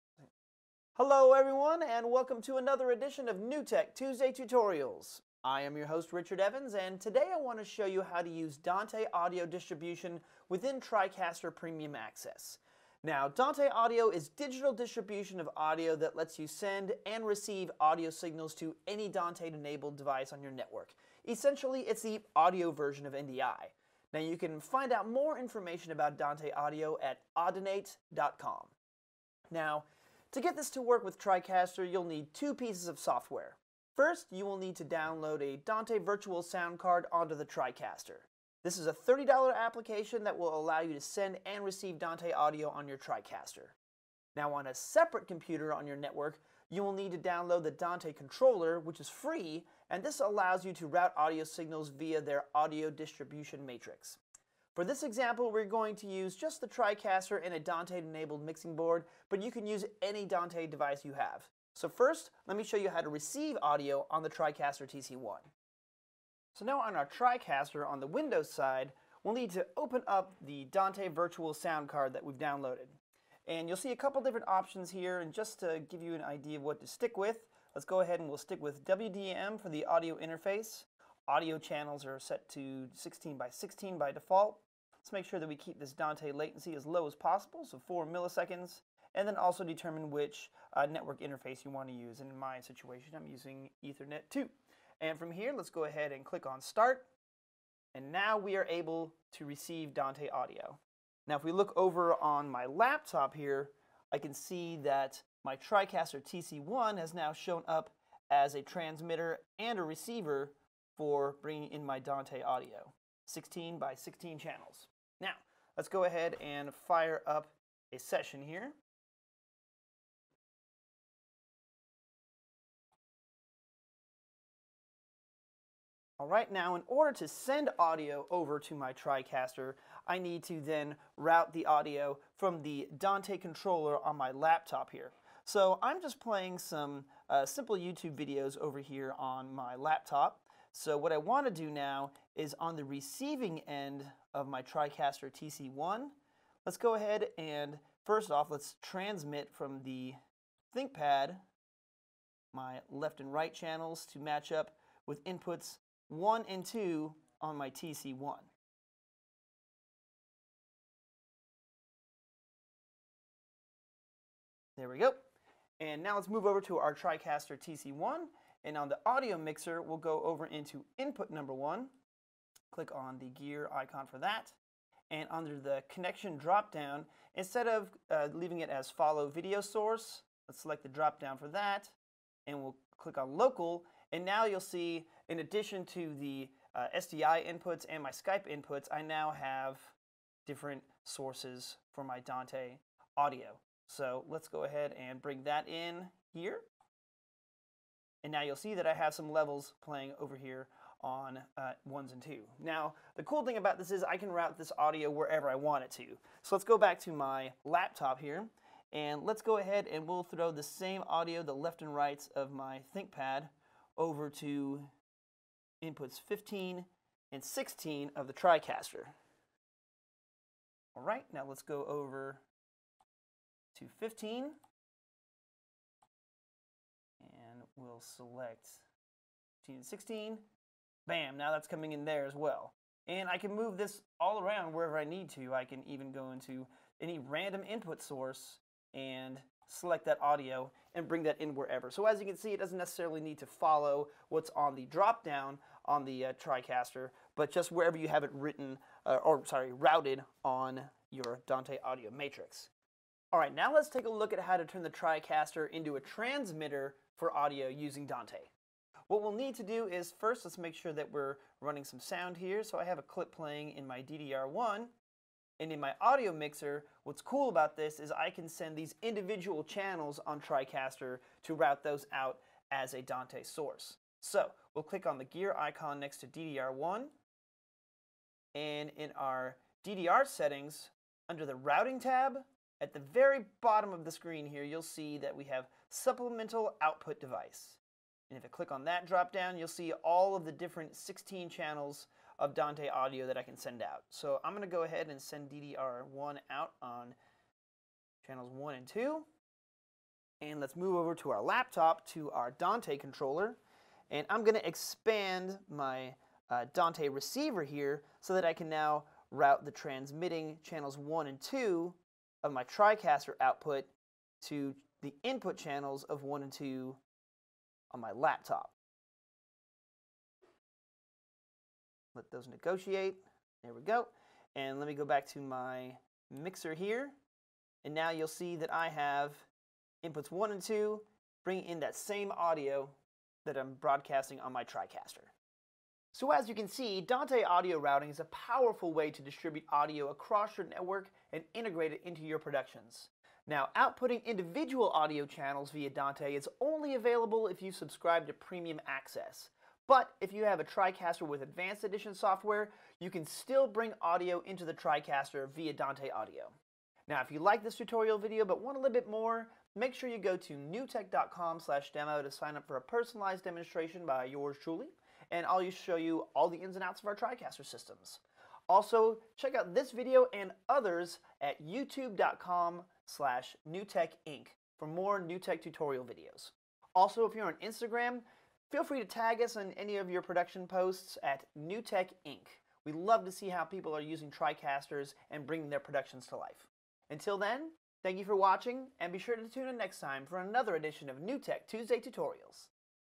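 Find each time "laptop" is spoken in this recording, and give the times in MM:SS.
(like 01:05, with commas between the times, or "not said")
01:42, 02:14, 02:19, 03:27, 05:01, 05:18.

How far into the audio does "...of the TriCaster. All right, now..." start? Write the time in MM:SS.
03:38.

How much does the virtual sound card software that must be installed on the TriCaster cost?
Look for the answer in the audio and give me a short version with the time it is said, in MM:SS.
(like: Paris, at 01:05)
$30, at 00:38.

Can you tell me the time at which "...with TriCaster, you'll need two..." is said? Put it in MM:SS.
00:31.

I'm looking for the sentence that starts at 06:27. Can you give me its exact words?
Until then, thank you for watching, and be sure to tune in next time for another edition of NewTek Tuesday Tutorials.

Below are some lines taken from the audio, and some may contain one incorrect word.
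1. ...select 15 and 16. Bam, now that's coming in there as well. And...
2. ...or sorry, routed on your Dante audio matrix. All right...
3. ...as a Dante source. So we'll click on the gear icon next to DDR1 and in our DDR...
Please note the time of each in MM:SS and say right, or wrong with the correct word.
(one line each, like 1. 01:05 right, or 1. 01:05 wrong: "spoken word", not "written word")
1. 03:48 right
2. 04:09 right
3. 04:32 right.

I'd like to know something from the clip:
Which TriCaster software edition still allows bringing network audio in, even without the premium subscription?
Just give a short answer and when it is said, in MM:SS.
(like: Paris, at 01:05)
Advanced Edition, at 05:51.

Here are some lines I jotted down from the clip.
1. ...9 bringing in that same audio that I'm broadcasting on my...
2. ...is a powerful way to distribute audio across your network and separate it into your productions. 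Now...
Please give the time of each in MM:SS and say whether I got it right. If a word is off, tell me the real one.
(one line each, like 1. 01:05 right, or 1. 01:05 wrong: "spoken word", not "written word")
1. 05:30 wrong: "2", not "9"
2. 05:38 wrong: "integrate", not "separate".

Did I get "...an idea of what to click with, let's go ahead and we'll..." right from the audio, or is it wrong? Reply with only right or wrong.
wrong.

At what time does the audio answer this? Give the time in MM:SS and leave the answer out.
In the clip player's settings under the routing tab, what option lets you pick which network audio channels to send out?
04:45.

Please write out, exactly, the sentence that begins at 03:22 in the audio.
Now, the cool thing about this is I can route this audio wherever I want it to.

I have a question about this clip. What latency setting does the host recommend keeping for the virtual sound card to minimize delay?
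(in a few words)
4 milliseconds.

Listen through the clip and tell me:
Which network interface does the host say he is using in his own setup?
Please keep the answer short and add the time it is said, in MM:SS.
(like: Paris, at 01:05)
Ethernet 2, at 01:33.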